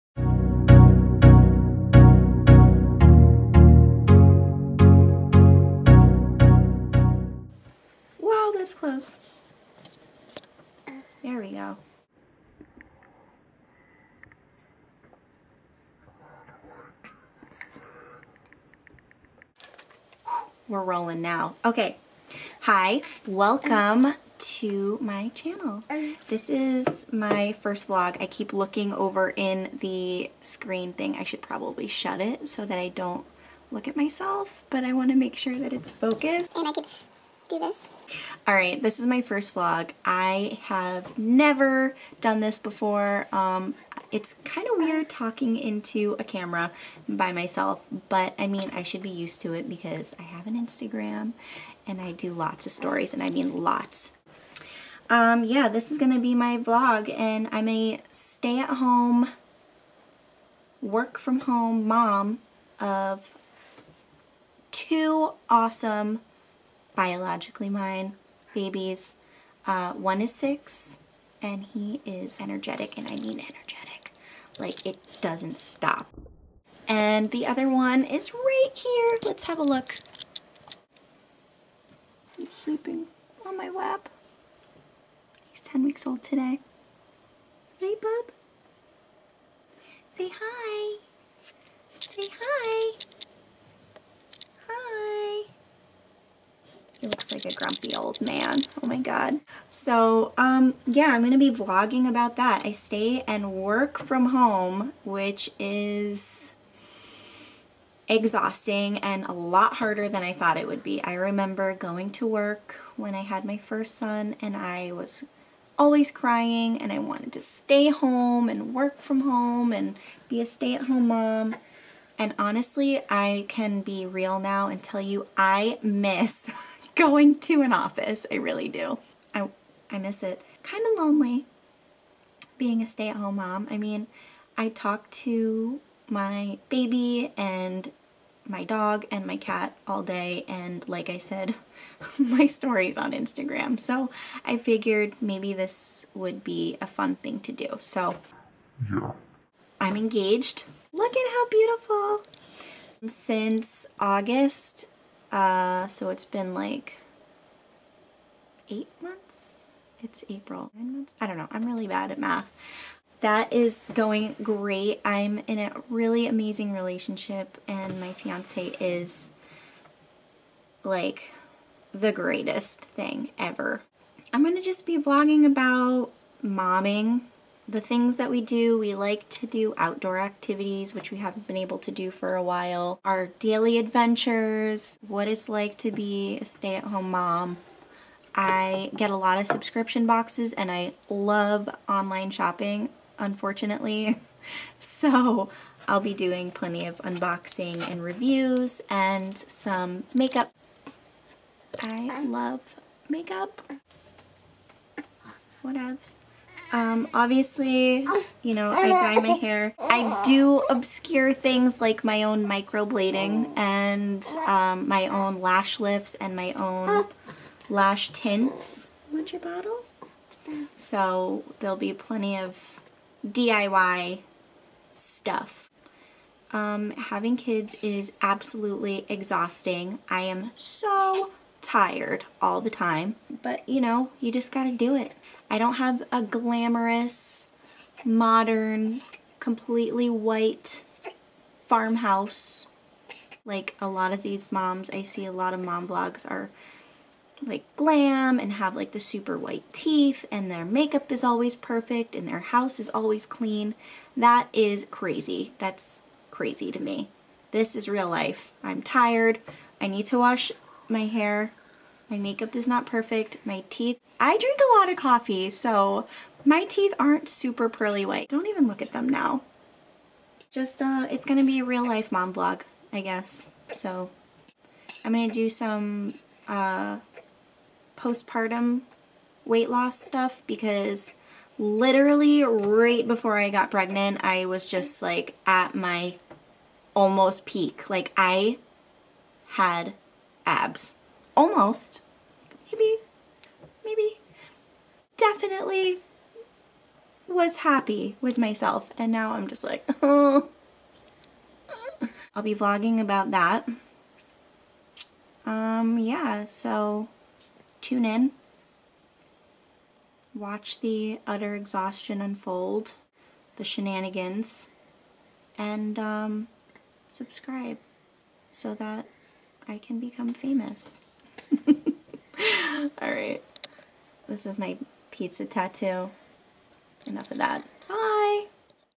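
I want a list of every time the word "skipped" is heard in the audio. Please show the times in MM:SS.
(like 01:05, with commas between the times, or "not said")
not said.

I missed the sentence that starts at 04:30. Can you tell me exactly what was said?
Just, uh, it's gonna be a real life mom vlog, I guess.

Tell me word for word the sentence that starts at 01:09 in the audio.
Uh, one is six, and he is energetic, and I mean energetic.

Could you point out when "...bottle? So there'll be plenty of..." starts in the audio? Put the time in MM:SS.
03:39.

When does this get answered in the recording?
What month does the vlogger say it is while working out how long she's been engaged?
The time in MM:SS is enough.
02:40.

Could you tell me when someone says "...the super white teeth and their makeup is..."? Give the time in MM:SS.
04:08.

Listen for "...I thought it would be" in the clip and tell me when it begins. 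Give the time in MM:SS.
01:50.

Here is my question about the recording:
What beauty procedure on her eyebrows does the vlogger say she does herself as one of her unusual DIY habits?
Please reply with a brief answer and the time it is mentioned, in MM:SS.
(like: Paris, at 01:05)
microblading, at 03:32.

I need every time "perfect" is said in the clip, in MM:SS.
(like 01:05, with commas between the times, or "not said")
04:11, 04:22.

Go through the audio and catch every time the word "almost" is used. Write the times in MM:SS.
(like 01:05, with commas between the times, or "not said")
04:46, 04:51.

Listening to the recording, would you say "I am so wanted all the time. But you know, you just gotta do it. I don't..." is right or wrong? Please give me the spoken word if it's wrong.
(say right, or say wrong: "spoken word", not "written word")
wrong: "tired", not "wanted".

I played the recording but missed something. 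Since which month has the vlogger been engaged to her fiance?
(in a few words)
August.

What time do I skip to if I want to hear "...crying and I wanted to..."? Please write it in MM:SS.
01:56.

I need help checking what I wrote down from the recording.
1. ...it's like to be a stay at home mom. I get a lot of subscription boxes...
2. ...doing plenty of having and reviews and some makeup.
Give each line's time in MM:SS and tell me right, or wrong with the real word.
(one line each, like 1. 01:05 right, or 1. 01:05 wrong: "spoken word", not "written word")
1. 03:05 right
2. 03:16 wrong: "unboxing", not "having".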